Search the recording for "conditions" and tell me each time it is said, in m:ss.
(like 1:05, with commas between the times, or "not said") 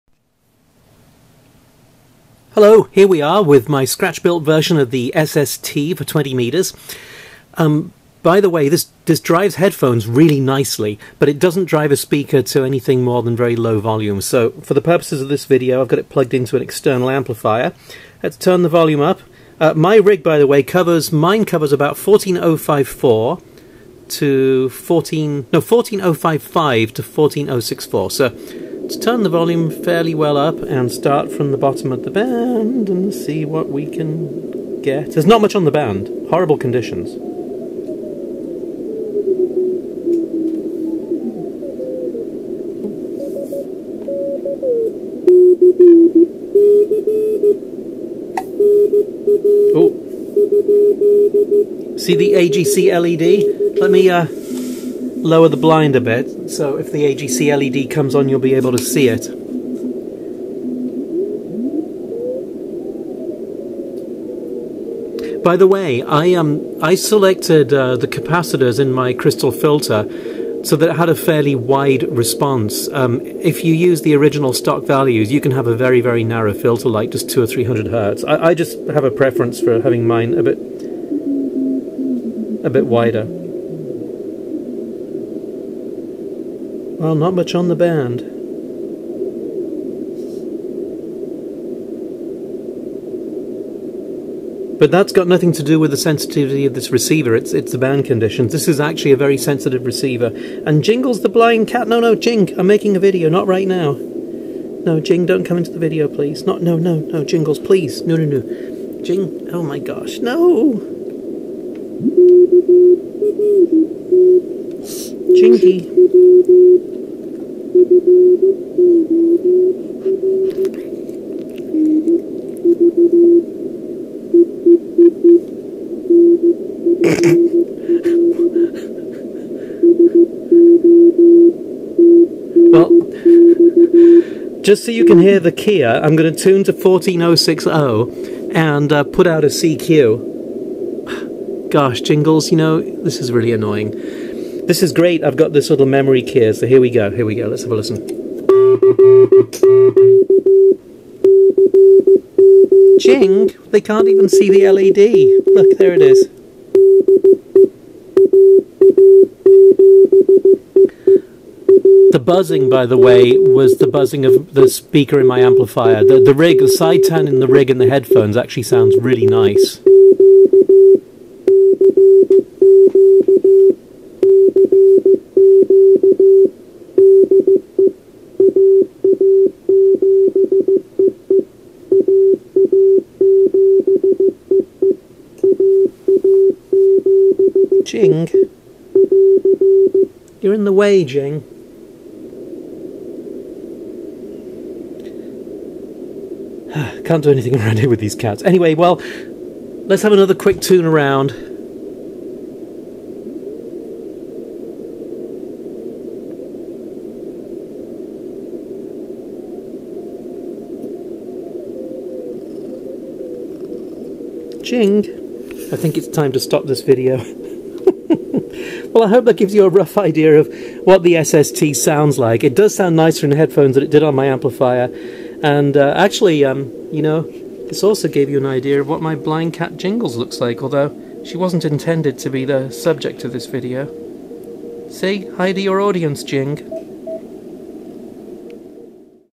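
0:36, 1:38.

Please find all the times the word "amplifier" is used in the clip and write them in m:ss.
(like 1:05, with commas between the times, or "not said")
0:17, 2:45, 3:44.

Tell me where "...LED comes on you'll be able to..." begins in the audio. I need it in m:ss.
0:57.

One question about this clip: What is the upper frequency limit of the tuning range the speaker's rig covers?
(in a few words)
14064.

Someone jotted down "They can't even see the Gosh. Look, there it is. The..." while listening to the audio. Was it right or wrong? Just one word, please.
wrong.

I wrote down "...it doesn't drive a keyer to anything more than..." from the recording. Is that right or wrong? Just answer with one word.
wrong.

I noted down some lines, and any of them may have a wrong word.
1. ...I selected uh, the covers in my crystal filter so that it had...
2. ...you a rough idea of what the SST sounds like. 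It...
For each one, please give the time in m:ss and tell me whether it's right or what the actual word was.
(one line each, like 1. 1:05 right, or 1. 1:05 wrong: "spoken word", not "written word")
1. 1:06 wrong: "capacitors", not "covers"
2. 3:39 right.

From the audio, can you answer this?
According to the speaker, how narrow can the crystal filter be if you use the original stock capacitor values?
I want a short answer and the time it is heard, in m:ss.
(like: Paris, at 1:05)
two or three hundred hertz, at 1:17.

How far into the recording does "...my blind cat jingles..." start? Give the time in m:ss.
3:49.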